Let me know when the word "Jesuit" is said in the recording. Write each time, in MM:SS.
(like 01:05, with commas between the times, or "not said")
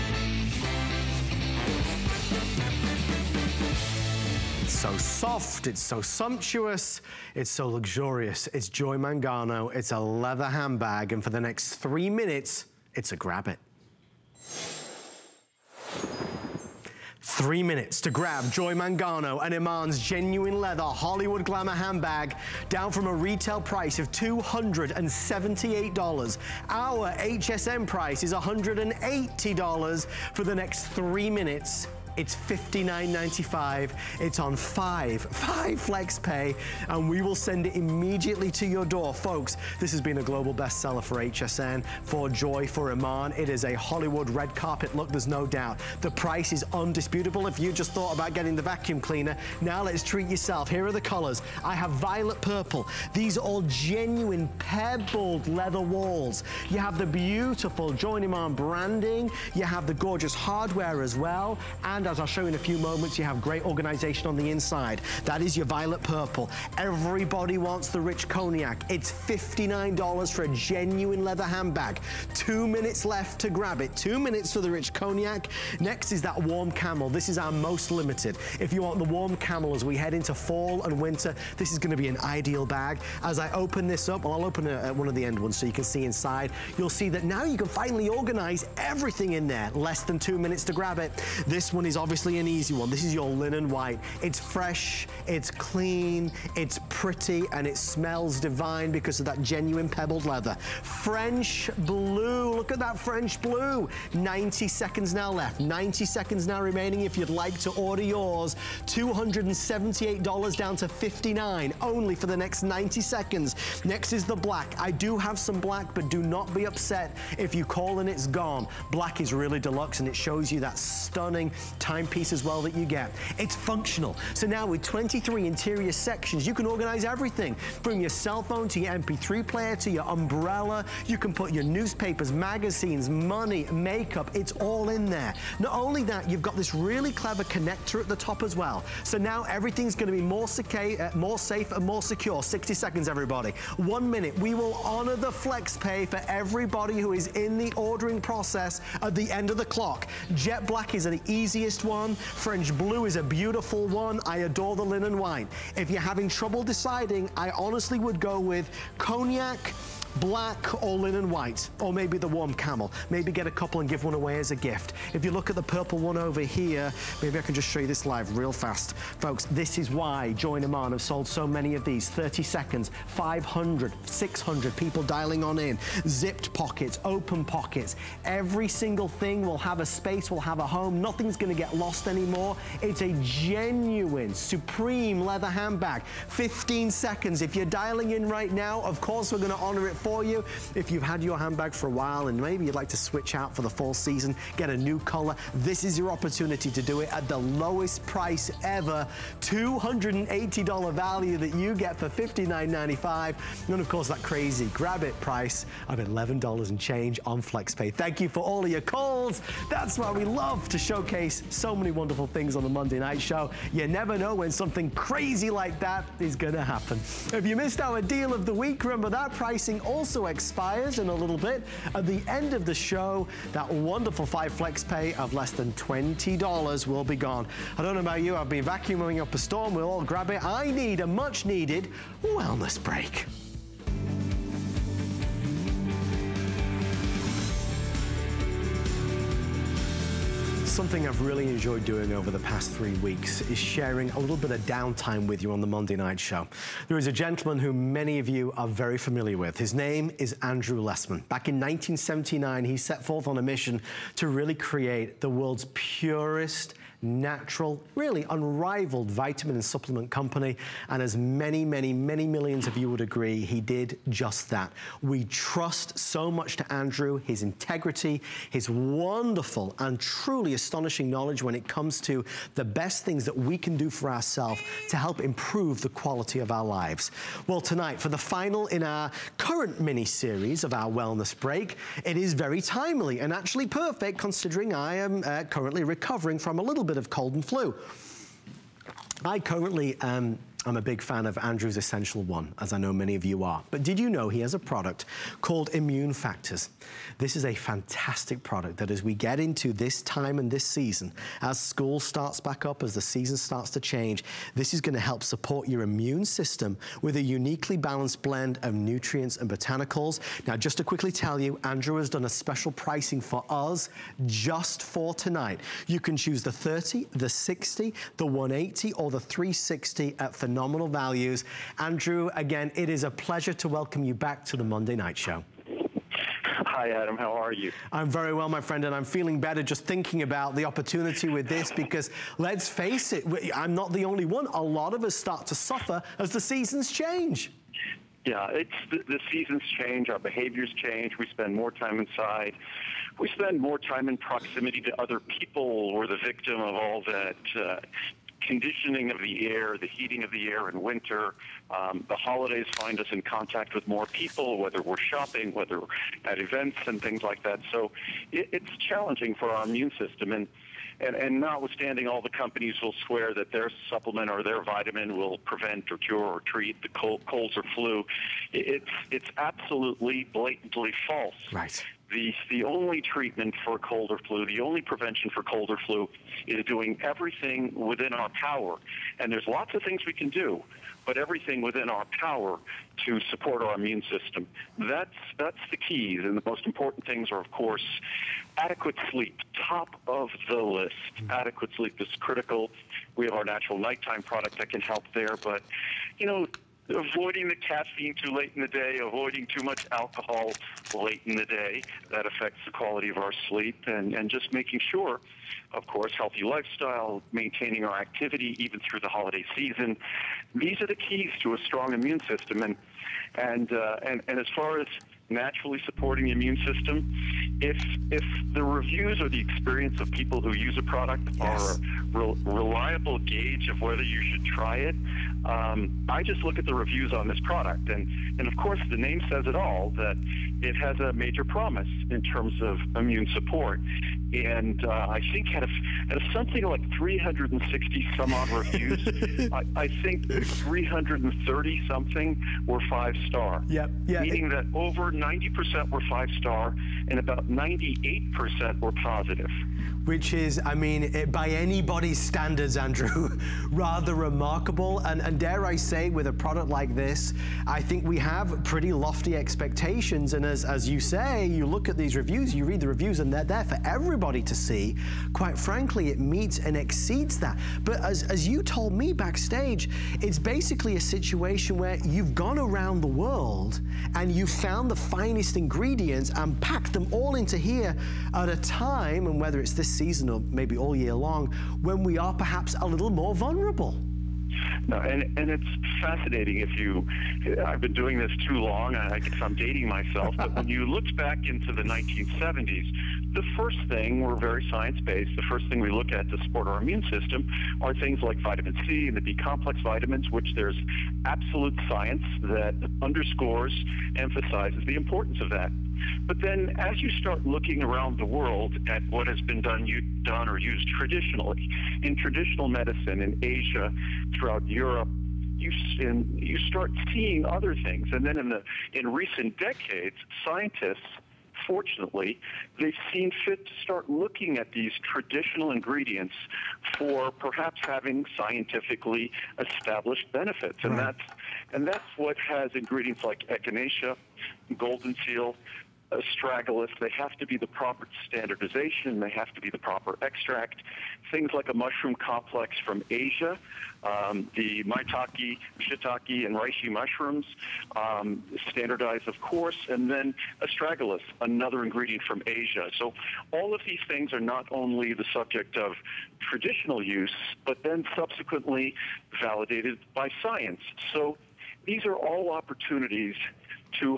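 not said.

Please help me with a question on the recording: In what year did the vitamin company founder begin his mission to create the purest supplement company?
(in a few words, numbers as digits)
1979.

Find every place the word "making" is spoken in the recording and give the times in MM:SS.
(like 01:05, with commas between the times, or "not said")
06:44.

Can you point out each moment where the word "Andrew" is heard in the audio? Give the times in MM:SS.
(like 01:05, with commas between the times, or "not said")
04:10, 04:26, 04:51, 05:11, 05:21, 07:32.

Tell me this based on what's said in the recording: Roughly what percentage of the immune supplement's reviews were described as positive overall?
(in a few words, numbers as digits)
98 percent.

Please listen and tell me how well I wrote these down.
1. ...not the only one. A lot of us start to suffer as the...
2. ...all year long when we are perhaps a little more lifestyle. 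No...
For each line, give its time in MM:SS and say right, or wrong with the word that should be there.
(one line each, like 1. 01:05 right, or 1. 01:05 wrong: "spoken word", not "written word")
1. 05:33 right
2. 08:00 wrong: "vulnerable", not "lifestyle".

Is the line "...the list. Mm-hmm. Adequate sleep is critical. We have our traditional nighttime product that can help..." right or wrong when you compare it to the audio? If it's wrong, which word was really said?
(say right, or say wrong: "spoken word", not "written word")
wrong: "natural", not "traditional".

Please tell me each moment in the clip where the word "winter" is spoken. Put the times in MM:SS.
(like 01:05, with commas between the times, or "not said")
01:21, 05:50.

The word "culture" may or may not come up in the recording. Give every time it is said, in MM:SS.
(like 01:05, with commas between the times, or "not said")
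not said.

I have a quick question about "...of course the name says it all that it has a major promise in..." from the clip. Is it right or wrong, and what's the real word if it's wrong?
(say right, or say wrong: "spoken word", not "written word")
right.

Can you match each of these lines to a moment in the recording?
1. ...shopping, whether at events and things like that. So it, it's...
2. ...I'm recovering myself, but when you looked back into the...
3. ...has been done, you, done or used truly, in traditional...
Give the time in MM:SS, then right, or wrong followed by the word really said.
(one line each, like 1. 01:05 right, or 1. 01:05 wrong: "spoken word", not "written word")
1. 05:55 right
2. 08:09 wrong: "dating", not "recovering"
3. 08:29 wrong: "traditionally", not "truly".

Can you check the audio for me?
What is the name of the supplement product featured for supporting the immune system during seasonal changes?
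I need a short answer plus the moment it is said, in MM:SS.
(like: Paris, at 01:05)
Immune Factors, at 04:55.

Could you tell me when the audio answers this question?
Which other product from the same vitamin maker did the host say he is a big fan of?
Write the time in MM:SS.
04:51.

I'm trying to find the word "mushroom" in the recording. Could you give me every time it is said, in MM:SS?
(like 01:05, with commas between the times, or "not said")
09:01, 09:06.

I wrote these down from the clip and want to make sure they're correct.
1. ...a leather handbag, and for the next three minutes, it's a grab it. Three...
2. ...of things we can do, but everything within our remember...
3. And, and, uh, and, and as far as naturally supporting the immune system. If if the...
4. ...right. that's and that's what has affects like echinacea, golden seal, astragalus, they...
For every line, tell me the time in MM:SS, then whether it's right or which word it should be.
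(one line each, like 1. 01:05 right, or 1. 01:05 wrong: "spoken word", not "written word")
1. 00:09 right
2. 06:19 wrong: "power", not "remember"
3. 06:52 right
4. 08:50 wrong: "ingredients", not "affects".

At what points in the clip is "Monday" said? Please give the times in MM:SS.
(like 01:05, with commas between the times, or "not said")
03:32, 04:05, 05:24.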